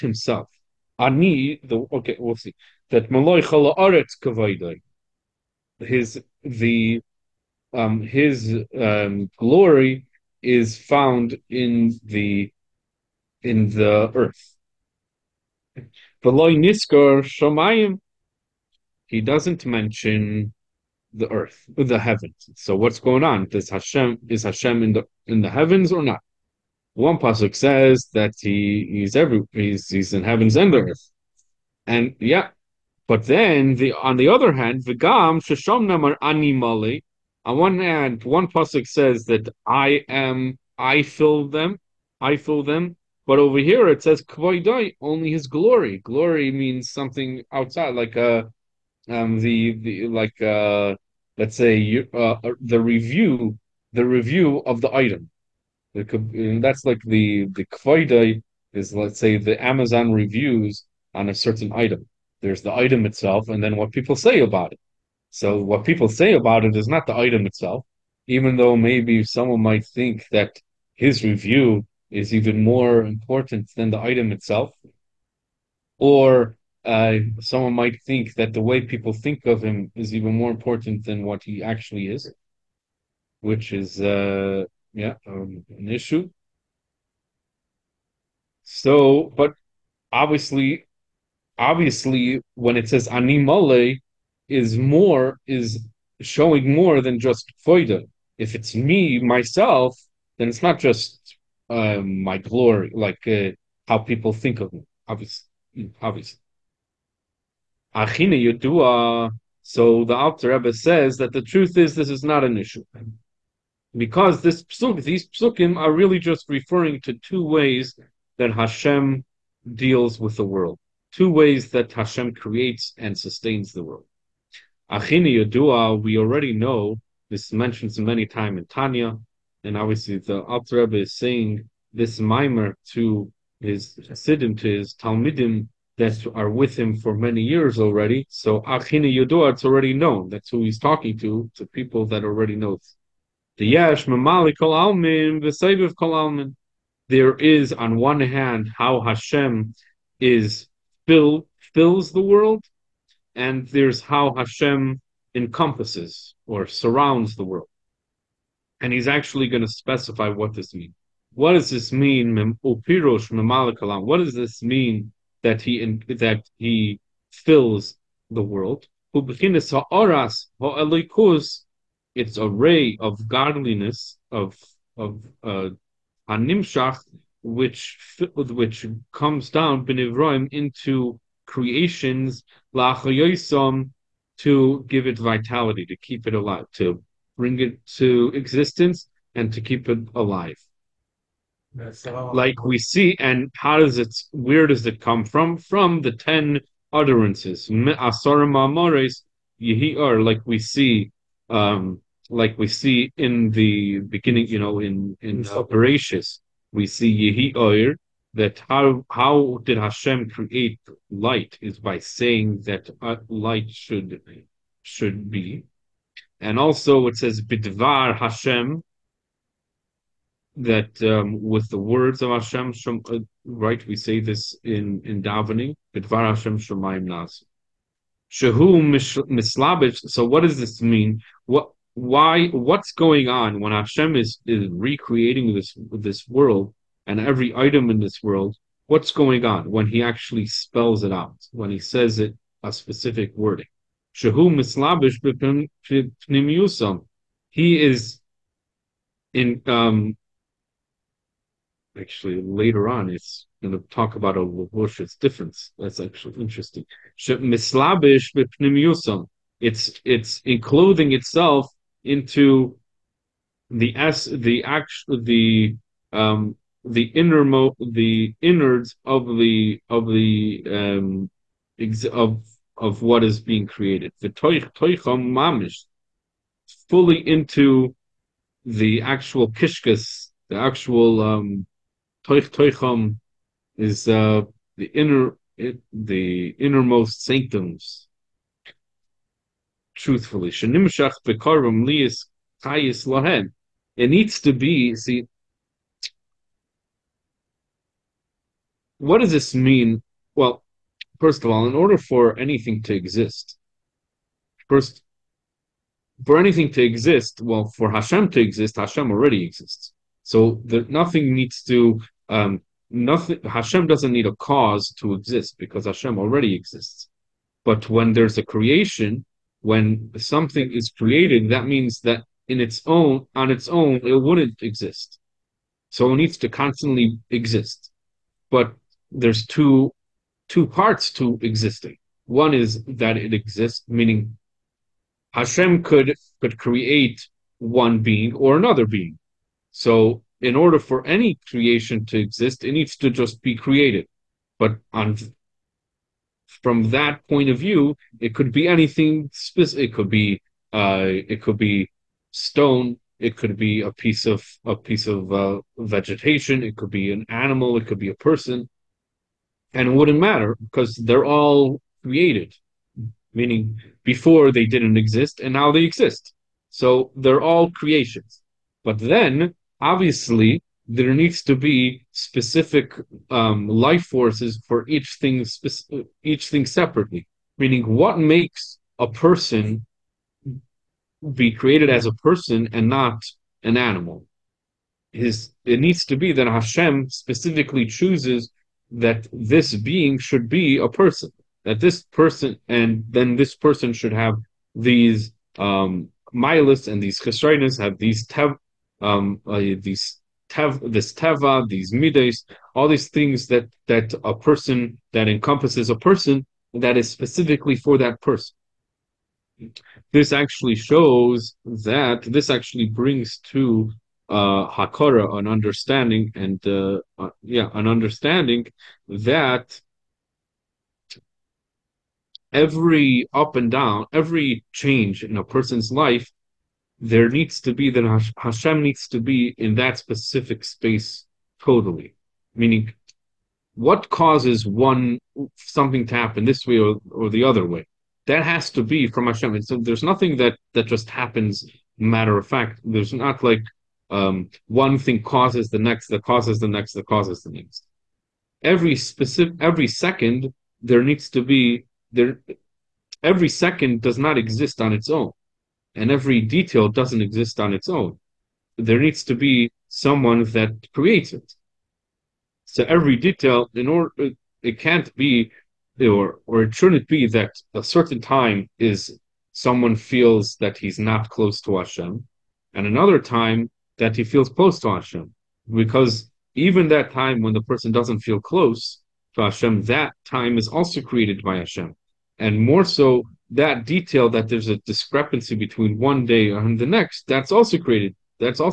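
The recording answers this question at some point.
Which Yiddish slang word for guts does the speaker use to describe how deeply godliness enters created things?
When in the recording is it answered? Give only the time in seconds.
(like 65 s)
279 s.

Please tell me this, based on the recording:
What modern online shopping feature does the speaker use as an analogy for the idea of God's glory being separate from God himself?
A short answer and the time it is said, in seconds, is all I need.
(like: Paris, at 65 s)
Amazon reviews, at 59 s.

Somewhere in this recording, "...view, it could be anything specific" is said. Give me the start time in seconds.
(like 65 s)
347 s.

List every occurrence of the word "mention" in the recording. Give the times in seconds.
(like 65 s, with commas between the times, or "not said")
19 s, 127 s.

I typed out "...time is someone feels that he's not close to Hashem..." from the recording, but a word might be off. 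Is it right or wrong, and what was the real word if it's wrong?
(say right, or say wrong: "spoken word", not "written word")
right.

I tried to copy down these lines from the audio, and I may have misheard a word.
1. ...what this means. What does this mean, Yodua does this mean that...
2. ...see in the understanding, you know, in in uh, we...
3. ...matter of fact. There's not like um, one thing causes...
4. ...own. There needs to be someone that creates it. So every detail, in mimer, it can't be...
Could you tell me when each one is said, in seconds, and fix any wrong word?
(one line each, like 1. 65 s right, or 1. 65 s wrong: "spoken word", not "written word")
1. 160 s wrong: "What", not "Yodua"
2. 202 s wrong: "beginning", not "understanding"
3. 441 s right
4. 457 s wrong: "order", not "mimer".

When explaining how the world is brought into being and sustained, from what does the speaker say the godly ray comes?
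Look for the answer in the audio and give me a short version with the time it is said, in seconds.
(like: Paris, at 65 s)
The ten utterances, at 196 s.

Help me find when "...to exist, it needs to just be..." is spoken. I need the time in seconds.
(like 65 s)
342 s.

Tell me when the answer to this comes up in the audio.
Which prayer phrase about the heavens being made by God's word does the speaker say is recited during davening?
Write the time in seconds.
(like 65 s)
225 s.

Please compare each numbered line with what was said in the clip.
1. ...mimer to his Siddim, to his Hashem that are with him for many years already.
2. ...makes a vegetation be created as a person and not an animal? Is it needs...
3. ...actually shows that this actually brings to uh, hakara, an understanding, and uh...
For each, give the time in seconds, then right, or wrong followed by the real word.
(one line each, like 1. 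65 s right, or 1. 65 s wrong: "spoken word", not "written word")
1. 132 s wrong: "Talmidim", not "Hashem"
2. 378 s wrong: "person", not "vegetation"
3. 410 s right.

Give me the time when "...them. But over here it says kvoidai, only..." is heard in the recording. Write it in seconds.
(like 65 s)
42 s.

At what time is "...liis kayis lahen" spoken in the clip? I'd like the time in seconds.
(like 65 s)
291 s.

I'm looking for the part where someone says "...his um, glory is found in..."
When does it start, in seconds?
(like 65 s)
8 s.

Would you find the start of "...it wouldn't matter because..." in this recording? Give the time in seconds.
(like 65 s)
359 s.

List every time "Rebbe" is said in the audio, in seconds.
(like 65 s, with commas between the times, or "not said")
110 s, 130 s.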